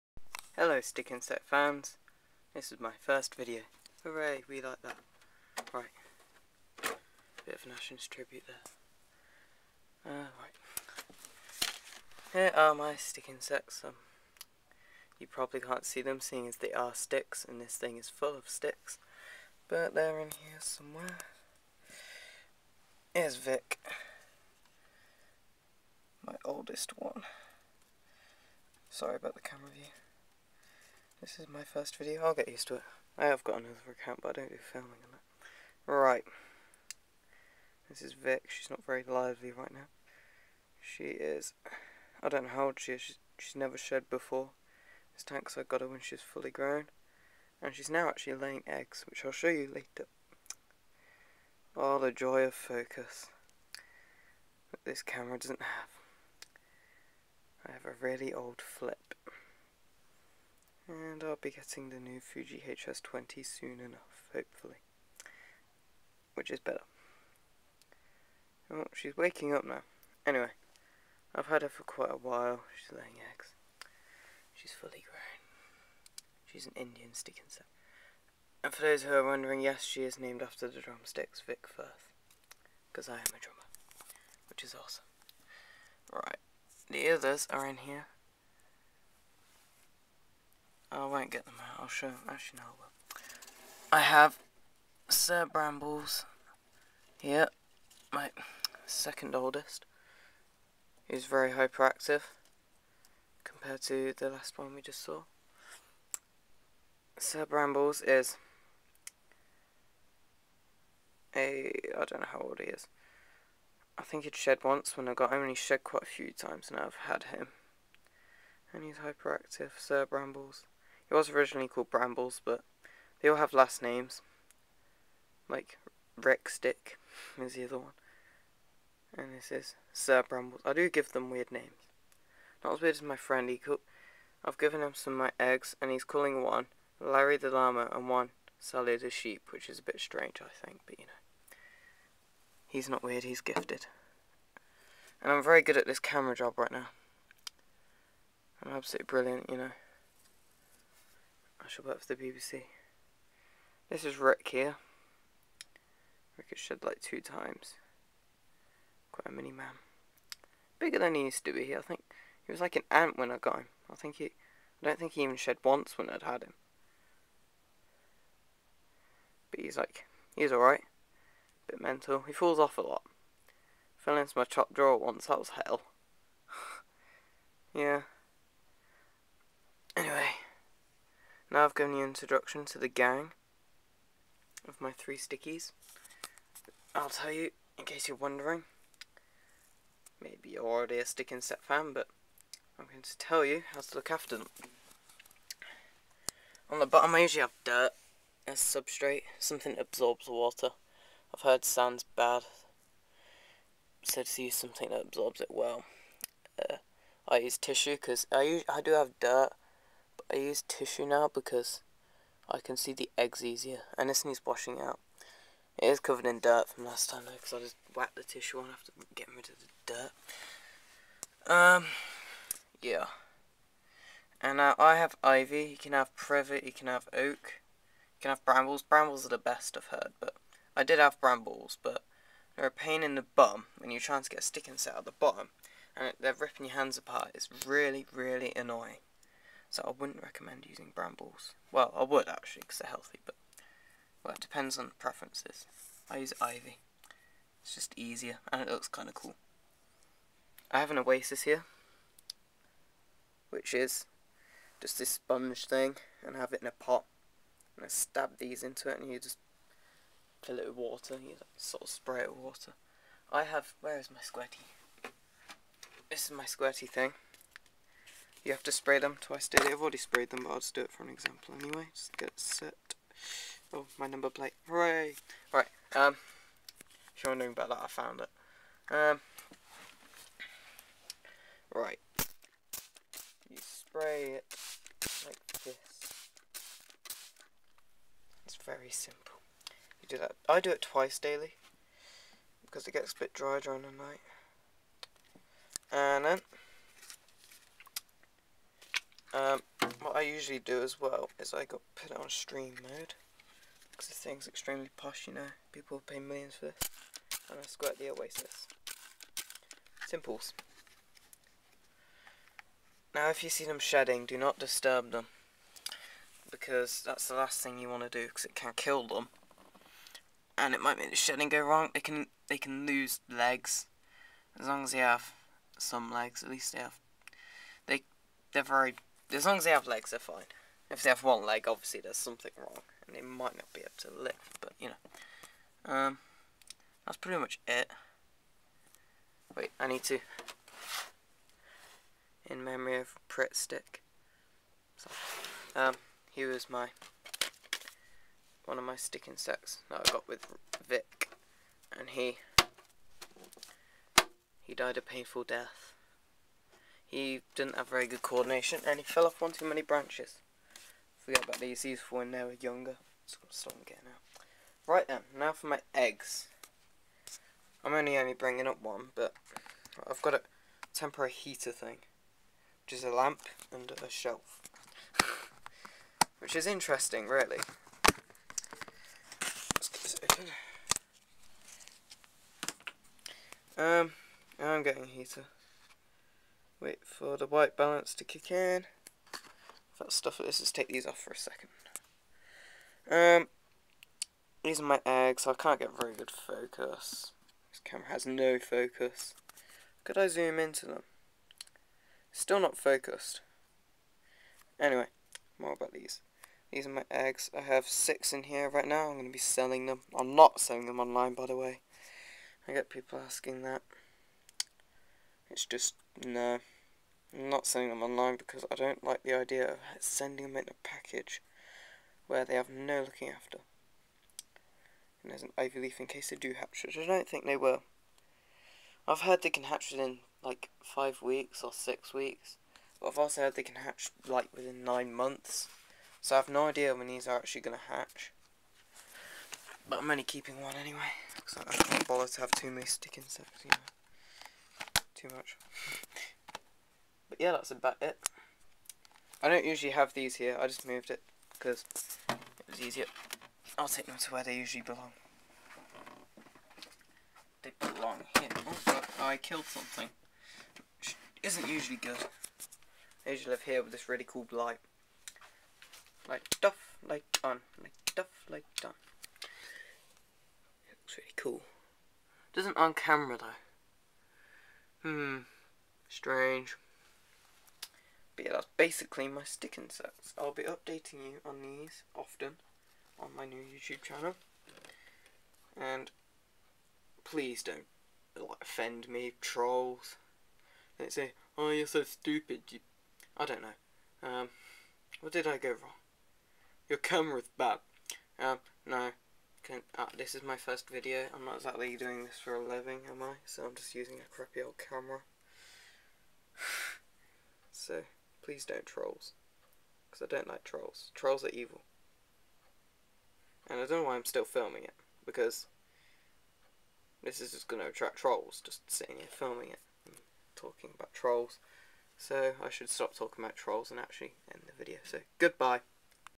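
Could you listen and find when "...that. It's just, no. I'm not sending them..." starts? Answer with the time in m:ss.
6:53.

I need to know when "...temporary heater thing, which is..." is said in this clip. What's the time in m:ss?
6:10.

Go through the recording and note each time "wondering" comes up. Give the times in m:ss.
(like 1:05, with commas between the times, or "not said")
1:19, 3:08, 4:37.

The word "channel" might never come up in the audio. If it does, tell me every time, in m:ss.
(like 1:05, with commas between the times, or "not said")
8:04.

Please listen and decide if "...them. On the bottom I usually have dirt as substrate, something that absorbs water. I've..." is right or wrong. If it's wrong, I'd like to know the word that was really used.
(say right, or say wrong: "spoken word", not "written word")
right.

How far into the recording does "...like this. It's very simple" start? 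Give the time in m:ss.
4:45.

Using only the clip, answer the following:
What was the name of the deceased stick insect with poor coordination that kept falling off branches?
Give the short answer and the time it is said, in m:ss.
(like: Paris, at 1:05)
Pritt Stick, at 5:43.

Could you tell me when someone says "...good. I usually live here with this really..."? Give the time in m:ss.
7:41.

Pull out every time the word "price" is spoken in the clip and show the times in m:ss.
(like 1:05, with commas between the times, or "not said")
not said.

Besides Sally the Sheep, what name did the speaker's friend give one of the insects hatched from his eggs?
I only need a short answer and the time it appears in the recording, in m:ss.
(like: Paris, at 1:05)
Larry the Llama, at 2:17.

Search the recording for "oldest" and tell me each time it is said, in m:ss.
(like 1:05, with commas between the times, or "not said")
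0:26, 1:39.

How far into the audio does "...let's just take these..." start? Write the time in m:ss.
6:30.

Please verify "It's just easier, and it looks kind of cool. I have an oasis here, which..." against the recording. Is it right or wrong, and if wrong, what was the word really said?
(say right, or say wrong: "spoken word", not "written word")
right.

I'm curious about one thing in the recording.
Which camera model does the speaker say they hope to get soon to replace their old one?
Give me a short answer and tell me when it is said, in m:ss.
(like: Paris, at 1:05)
Fuji HS20, at 1:02.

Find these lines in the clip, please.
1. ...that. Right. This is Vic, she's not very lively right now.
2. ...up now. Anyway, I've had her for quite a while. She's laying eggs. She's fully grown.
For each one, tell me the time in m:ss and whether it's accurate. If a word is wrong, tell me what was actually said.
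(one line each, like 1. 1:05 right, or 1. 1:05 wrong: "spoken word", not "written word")
1. 0:35 right
2. 1:09 right.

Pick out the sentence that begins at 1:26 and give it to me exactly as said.
The others are in here, I won't get them out.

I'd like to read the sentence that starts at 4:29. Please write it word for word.
I've already sprayed them, but I'll just do it for an example anyway.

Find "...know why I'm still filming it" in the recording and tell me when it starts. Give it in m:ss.
8:34.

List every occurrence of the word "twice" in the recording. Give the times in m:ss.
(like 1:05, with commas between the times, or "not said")
4:29, 4:50.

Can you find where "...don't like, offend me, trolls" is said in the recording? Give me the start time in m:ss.
8:07.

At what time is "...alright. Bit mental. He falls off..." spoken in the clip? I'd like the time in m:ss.
2:50.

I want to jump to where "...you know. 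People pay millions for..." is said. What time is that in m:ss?
5:05.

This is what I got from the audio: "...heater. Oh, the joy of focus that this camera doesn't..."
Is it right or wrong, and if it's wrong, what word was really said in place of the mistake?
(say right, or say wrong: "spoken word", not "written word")
wrong: "later", not "heater".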